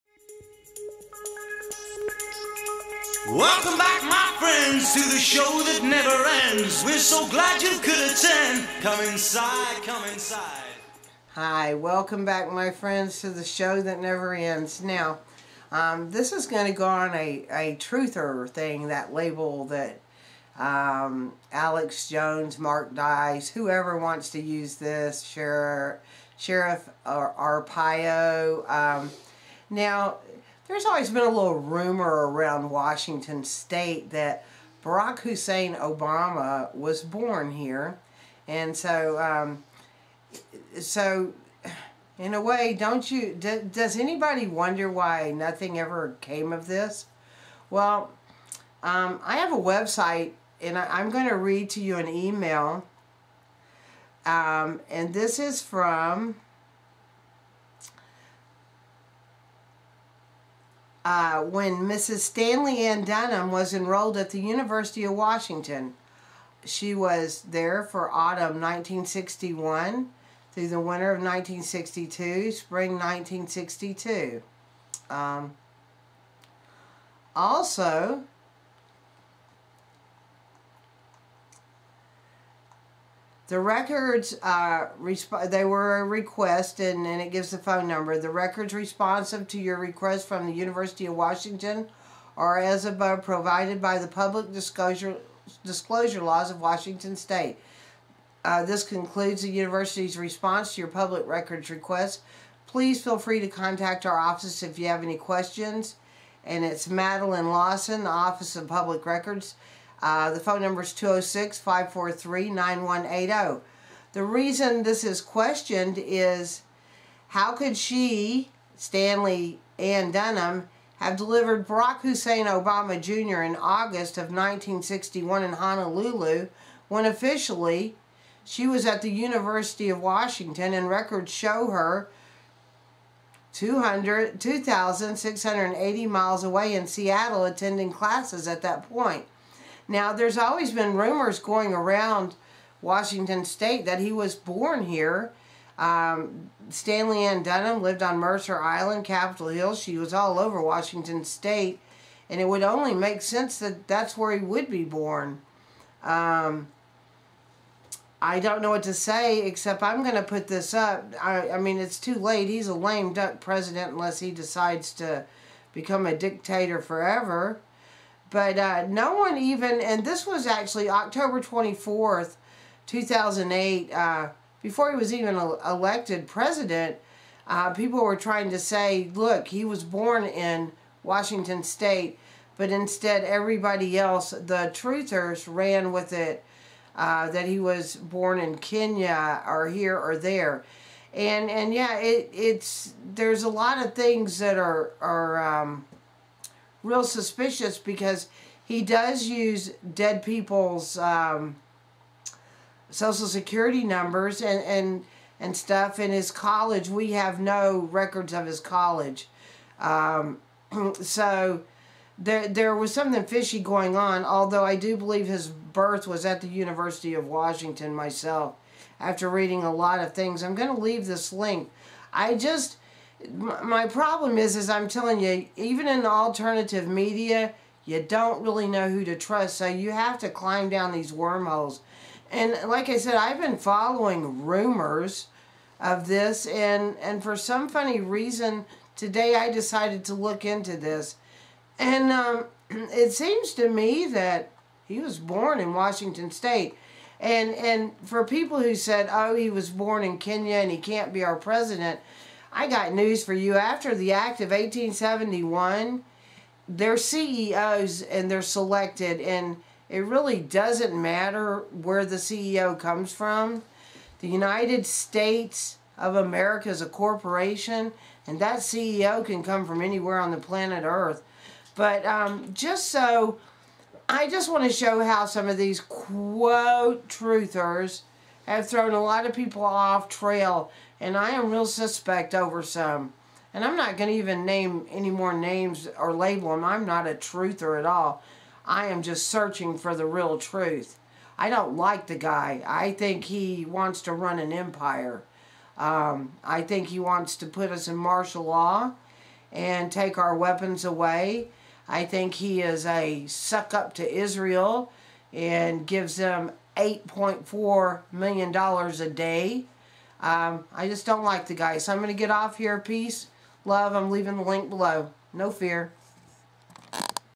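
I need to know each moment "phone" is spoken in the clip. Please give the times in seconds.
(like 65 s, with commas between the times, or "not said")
87 s, 110 s.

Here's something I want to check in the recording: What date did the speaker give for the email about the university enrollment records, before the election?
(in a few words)
October 24, 2008.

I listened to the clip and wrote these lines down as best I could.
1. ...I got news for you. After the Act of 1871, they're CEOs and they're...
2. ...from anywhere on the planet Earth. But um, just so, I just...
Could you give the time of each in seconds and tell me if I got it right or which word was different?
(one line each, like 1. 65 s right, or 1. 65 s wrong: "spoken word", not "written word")
1. 252 s right
2. 269 s right.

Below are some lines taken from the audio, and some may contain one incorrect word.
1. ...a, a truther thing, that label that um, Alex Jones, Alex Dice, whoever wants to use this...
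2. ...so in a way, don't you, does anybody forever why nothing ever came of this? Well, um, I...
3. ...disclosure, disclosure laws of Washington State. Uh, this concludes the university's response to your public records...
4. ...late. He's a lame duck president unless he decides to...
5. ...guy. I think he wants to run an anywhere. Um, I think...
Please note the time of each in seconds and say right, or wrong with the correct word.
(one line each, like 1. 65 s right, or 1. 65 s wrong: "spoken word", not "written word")
1. 17 s wrong: "Mark", not "Alex"
2. 40 s wrong: "wonder", not "forever"
3. 94 s right
4. 162 s right
5. 292 s wrong: "empire", not "anywhere".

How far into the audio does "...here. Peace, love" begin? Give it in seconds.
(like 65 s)
312 s.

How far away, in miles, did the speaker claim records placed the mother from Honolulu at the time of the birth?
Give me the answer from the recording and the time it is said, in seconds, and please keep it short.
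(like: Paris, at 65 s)
2,680 miles, at 133 s.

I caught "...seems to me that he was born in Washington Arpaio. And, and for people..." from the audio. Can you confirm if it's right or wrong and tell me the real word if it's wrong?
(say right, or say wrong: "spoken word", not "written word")
wrong: "State", not "Arpaio".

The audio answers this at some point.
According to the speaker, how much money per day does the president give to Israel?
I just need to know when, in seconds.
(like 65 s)
306 s.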